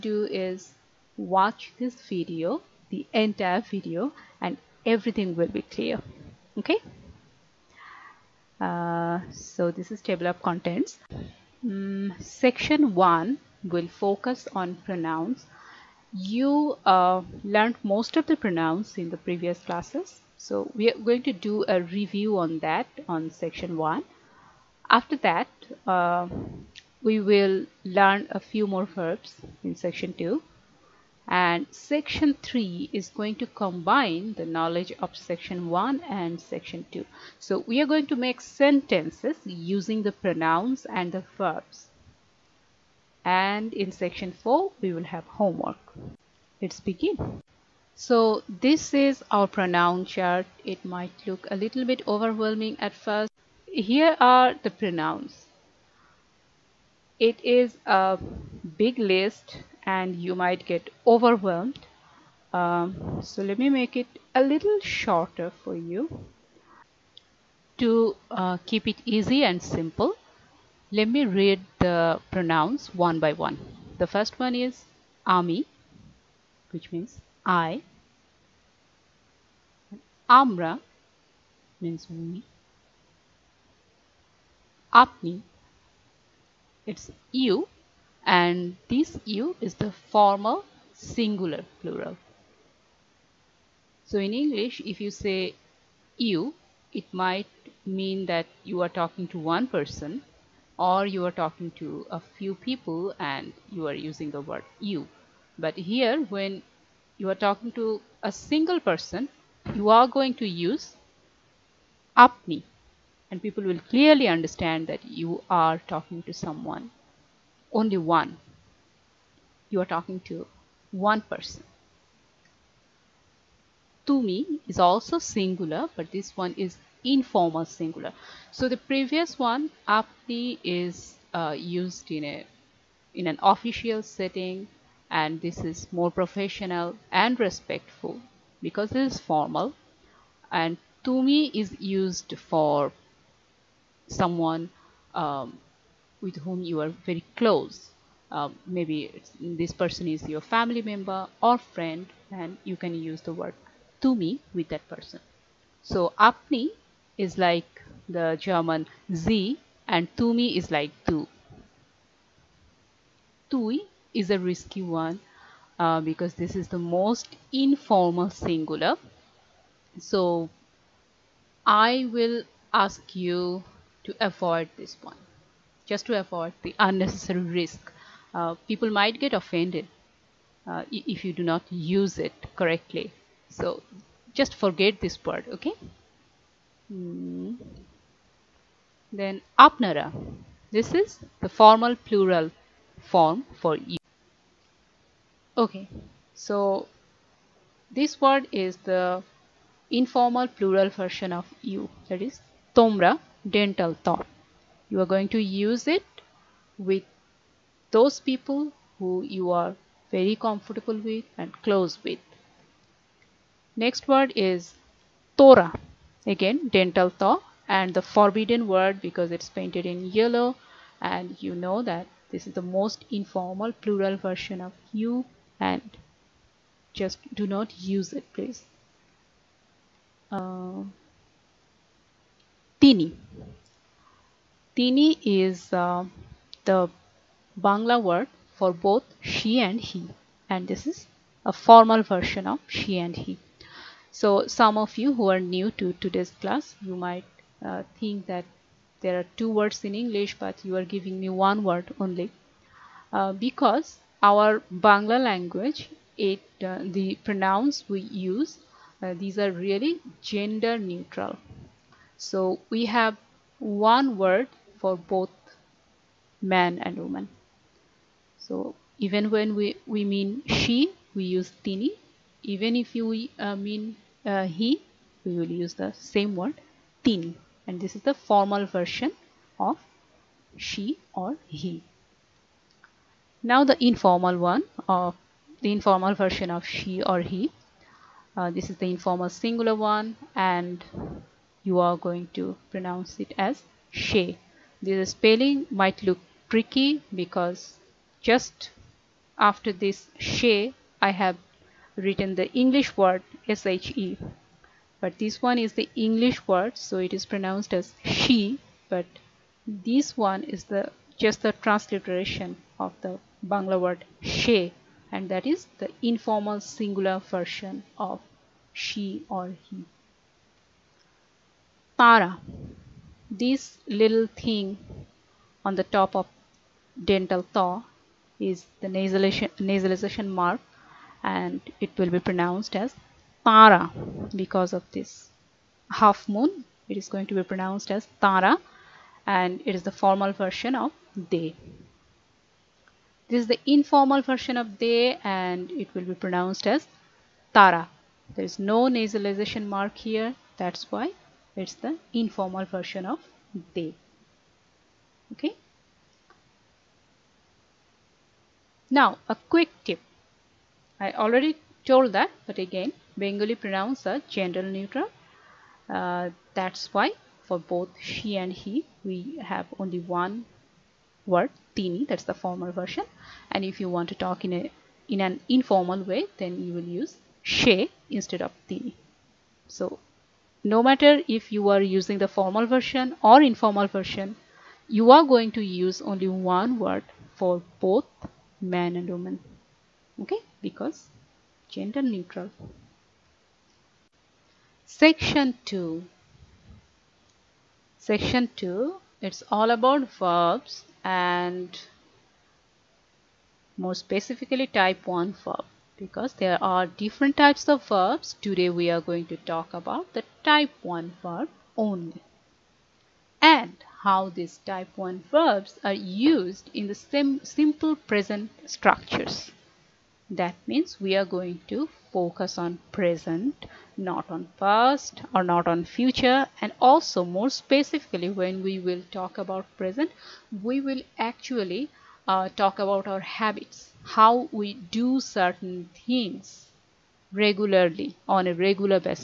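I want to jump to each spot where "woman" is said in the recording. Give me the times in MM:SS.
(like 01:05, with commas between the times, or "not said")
04:26, 06:29.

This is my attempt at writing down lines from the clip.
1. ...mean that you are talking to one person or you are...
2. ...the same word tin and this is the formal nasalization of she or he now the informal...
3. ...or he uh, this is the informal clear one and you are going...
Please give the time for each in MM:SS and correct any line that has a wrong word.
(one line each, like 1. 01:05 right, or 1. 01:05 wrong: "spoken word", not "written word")
1. 01:37 right
2. 04:35 wrong: "version", not "nasalization"
3. 04:47 wrong: "singular", not "clear".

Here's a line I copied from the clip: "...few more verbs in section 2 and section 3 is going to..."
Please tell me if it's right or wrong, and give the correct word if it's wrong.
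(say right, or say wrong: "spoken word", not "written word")
right.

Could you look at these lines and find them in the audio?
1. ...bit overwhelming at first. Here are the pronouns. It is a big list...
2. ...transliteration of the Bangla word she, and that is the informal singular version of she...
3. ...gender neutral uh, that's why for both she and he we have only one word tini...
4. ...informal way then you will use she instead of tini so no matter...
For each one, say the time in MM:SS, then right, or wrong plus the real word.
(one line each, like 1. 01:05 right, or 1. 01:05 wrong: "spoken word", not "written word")
1. 00:51 right
2. 05:11 right
3. 06:04 right
4. 06:15 right.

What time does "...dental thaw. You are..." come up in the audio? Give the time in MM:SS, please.
03:23.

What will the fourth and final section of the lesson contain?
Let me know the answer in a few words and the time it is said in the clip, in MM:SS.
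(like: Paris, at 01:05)
homework, at 00:45.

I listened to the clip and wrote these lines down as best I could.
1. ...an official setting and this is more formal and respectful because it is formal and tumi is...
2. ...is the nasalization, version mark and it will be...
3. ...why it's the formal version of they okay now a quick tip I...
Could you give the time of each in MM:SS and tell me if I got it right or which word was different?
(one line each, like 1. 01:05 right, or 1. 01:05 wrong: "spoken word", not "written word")
1. 02:13 wrong: "professional", not "formal"
2. 05:28 wrong: "nasalization", not "version"
3. 05:50 wrong: "informal", not "formal".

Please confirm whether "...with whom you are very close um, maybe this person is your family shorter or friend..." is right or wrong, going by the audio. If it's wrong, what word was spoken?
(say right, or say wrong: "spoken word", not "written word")
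wrong: "member", not "shorter".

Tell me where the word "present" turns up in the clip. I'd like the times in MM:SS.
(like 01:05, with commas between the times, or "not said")
06:58, 07:02, 07:09.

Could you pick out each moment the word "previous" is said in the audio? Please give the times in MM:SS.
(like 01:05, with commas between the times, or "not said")
00:19, 02:08.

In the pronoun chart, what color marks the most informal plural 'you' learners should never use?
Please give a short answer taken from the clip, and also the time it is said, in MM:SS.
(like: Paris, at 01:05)
yellow, at 03:40.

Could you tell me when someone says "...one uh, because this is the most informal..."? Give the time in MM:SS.
02:44.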